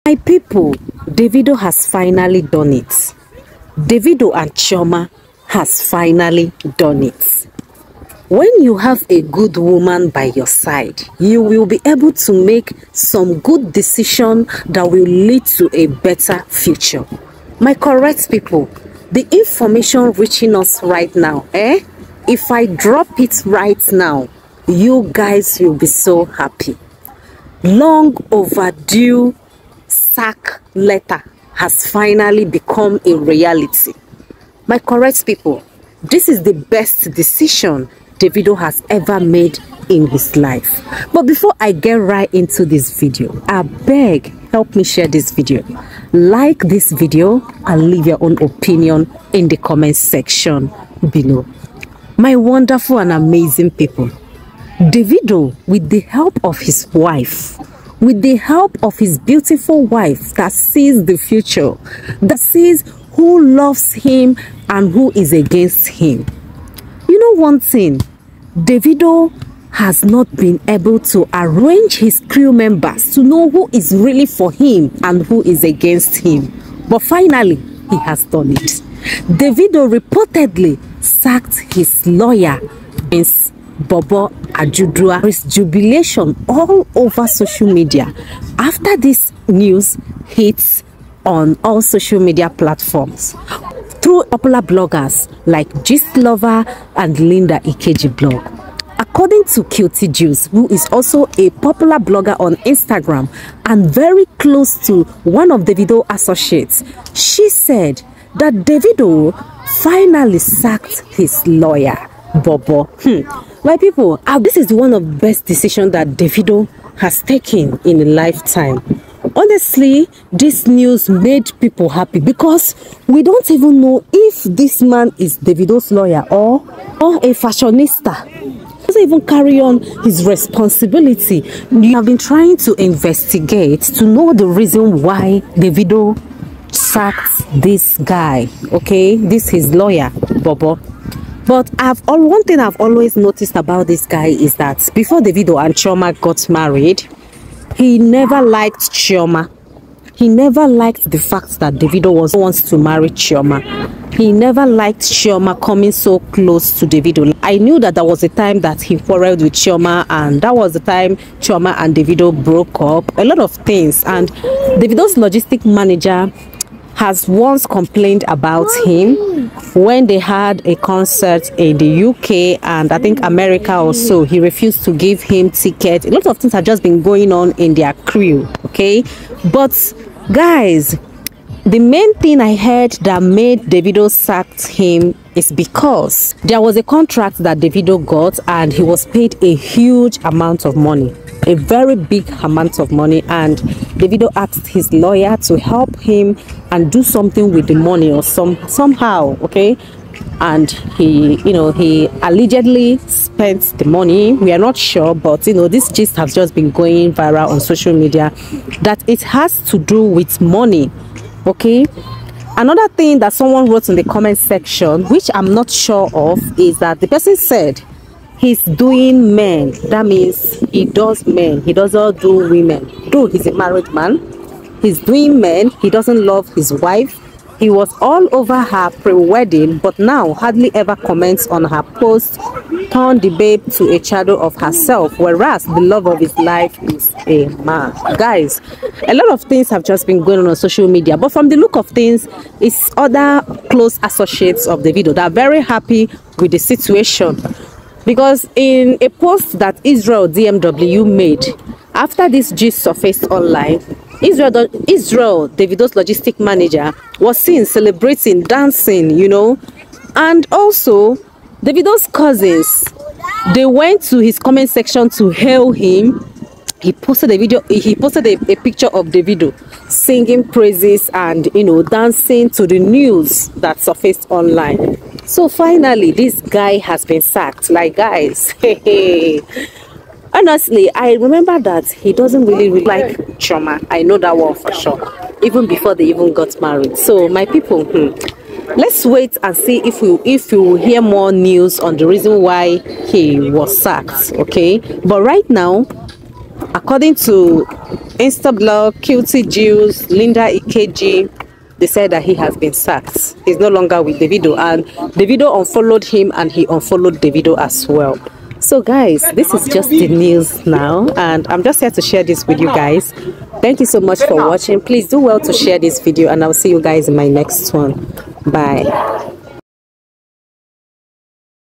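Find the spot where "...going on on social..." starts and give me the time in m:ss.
4:00.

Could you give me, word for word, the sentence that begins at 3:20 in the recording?
And he, you know, he allegedly spent the money.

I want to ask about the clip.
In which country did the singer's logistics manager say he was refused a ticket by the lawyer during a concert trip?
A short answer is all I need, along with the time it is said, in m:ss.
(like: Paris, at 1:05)
The UK, at 2:51.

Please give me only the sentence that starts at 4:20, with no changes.
And also, Davido's cousins, they went to his comment section to hail him.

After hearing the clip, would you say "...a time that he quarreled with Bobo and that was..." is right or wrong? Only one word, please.
wrong.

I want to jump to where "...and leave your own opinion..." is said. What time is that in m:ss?
0:47.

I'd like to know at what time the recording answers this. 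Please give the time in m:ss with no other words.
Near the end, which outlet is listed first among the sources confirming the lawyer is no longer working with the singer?
4:58.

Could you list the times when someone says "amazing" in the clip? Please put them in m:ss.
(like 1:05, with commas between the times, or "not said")
0:53.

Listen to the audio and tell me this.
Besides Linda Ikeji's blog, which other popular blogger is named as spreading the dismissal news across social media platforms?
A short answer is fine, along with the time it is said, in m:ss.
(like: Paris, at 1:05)
Gist Lover, at 1:35.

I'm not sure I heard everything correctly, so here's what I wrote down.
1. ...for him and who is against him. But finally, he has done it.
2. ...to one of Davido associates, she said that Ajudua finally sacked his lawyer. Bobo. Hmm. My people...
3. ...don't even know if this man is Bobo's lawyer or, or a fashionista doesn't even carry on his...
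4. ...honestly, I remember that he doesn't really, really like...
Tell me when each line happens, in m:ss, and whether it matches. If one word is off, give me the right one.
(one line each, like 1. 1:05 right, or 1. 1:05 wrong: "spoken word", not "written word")
1. 1:14 right
2. 1:44 wrong: "Davido", not "Ajudua"
3. 2:03 wrong: "Davido", not "Bobo"
4. 4:40 right.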